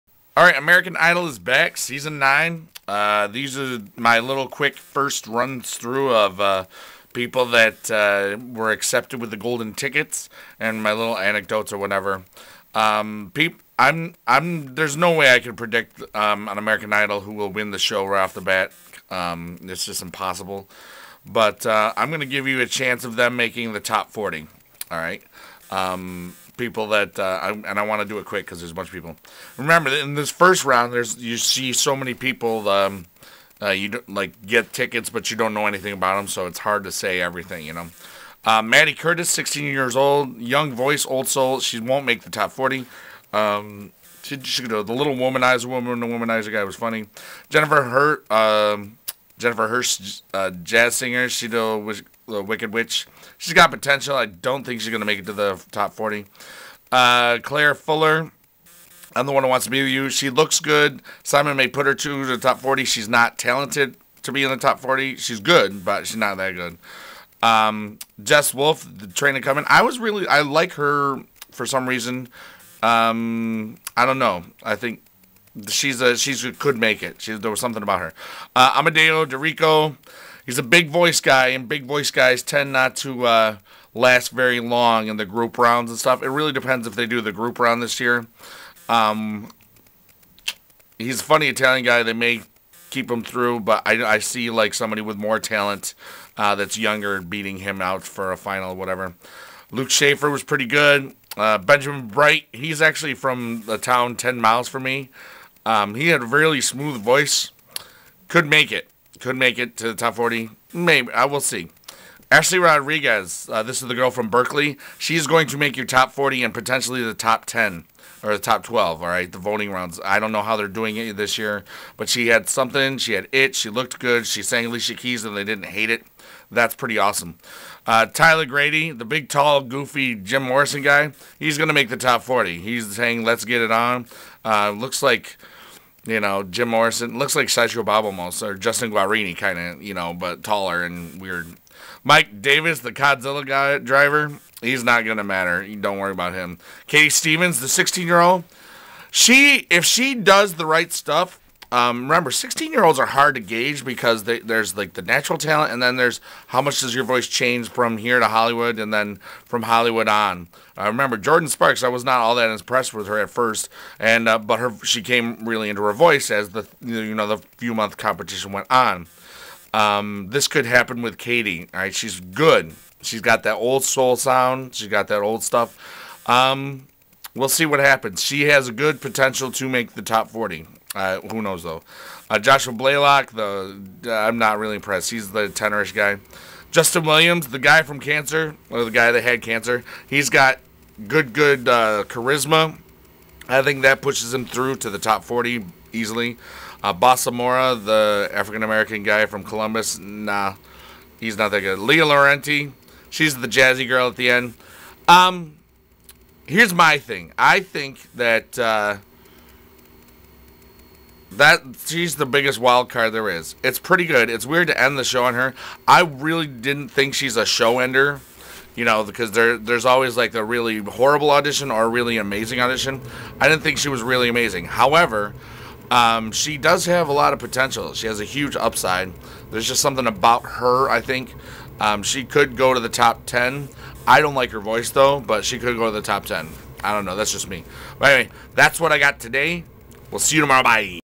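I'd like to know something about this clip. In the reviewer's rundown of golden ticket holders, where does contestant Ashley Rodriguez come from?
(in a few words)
Berkeley.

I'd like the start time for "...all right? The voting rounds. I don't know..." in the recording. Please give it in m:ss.
1:59.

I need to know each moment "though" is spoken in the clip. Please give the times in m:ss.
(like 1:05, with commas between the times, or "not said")
3:01, 3:54.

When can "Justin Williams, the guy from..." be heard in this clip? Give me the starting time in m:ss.
3:06.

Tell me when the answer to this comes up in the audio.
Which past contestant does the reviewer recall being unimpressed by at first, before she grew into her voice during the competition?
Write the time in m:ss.
2:41.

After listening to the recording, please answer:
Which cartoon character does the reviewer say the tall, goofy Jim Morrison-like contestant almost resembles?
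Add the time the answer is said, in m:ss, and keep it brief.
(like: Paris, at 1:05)
Sideshow Bob, at 2:17.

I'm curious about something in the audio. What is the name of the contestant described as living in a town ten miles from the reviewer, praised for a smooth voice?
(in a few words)
Benjamin Bright.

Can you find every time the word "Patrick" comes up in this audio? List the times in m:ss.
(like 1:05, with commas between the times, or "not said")
not said.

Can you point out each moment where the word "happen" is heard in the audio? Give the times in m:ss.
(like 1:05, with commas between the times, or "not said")
2:50, 2:57.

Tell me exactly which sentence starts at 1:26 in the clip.
It really depends if they do the group round this year.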